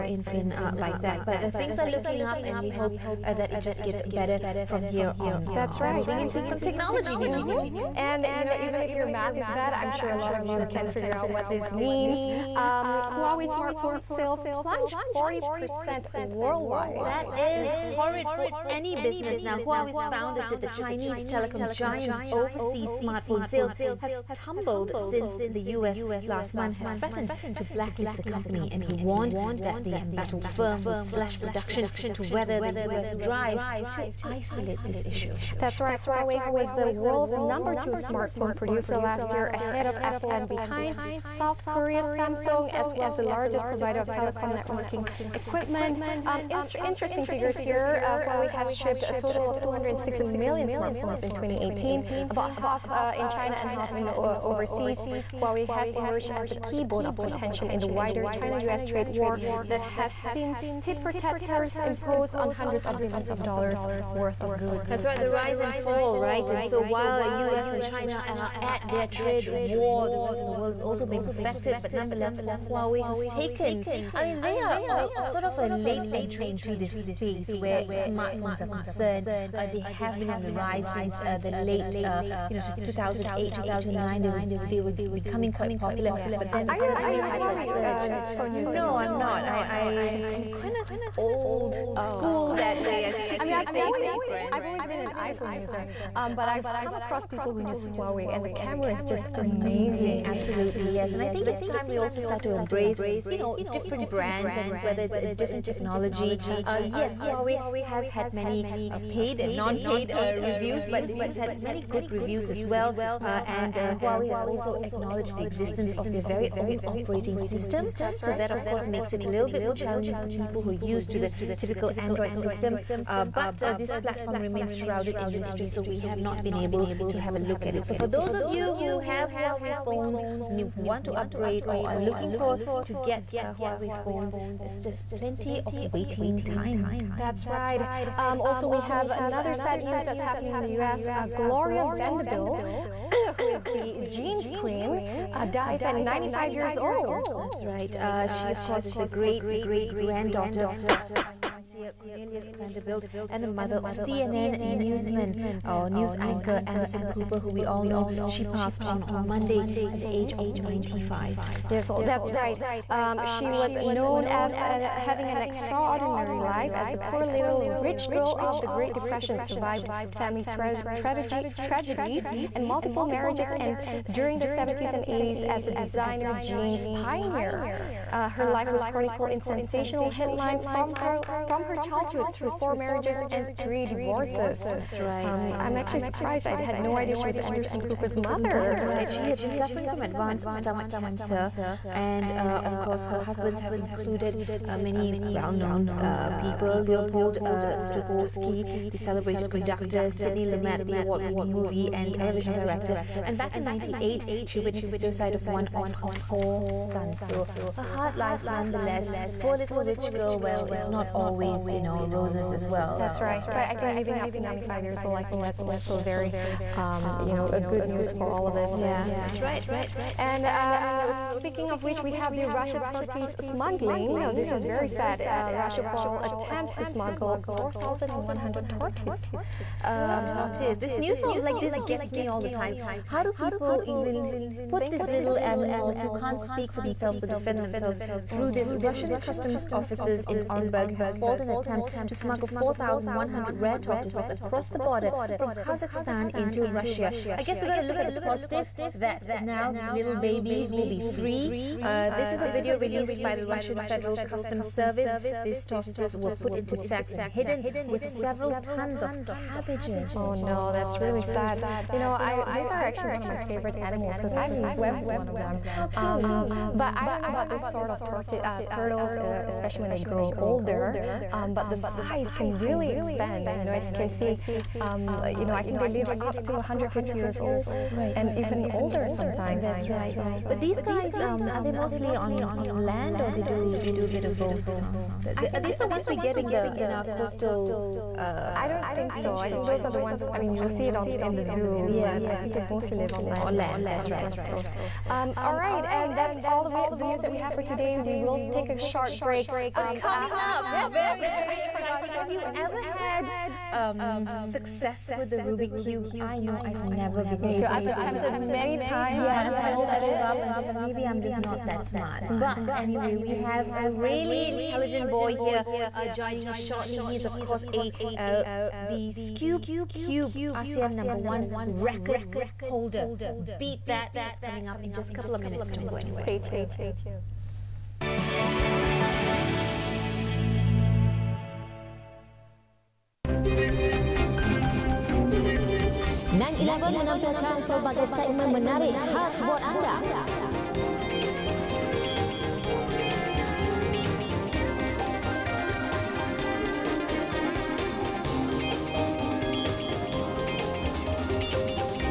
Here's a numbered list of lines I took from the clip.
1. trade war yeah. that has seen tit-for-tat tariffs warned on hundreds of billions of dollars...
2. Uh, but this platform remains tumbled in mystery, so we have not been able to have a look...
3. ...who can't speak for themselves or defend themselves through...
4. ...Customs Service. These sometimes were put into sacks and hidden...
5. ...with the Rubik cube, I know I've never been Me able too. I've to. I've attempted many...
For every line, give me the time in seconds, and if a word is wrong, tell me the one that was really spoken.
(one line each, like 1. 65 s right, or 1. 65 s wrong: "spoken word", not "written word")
1. 58 s wrong: "imposed", not "warned"
2. 122 s wrong: "shrouded", not "tumbled"
3. 236 s right
4. 254 s wrong: "tortoises", not "sometimes"
5. 305 s right.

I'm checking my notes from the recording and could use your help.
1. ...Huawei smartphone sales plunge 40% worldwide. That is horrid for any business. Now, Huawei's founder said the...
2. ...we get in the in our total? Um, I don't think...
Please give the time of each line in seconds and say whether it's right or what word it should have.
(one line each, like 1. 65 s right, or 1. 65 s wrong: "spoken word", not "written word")
1. 13 s right
2. 286 s wrong: "coastal", not "total".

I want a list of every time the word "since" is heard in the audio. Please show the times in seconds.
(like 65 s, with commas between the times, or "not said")
24 s, 80 s.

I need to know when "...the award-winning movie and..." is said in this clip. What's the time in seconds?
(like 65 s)
200 s.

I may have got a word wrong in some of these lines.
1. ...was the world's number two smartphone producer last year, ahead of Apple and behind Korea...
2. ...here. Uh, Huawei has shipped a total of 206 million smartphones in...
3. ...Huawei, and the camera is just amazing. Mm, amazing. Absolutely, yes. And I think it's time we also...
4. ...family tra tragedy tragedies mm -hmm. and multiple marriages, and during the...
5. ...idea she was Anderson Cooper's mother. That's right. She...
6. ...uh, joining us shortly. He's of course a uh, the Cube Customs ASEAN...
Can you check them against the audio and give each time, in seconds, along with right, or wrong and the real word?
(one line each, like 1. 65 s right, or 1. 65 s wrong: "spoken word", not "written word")
1. 36 s wrong: "South", not "Korea"
2. 47 s right
3. 97 s right
4. 170 s right
5. 186 s right
6. 315 s wrong: "Cube", not "Customs".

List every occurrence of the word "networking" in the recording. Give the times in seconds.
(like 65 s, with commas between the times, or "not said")
44 s.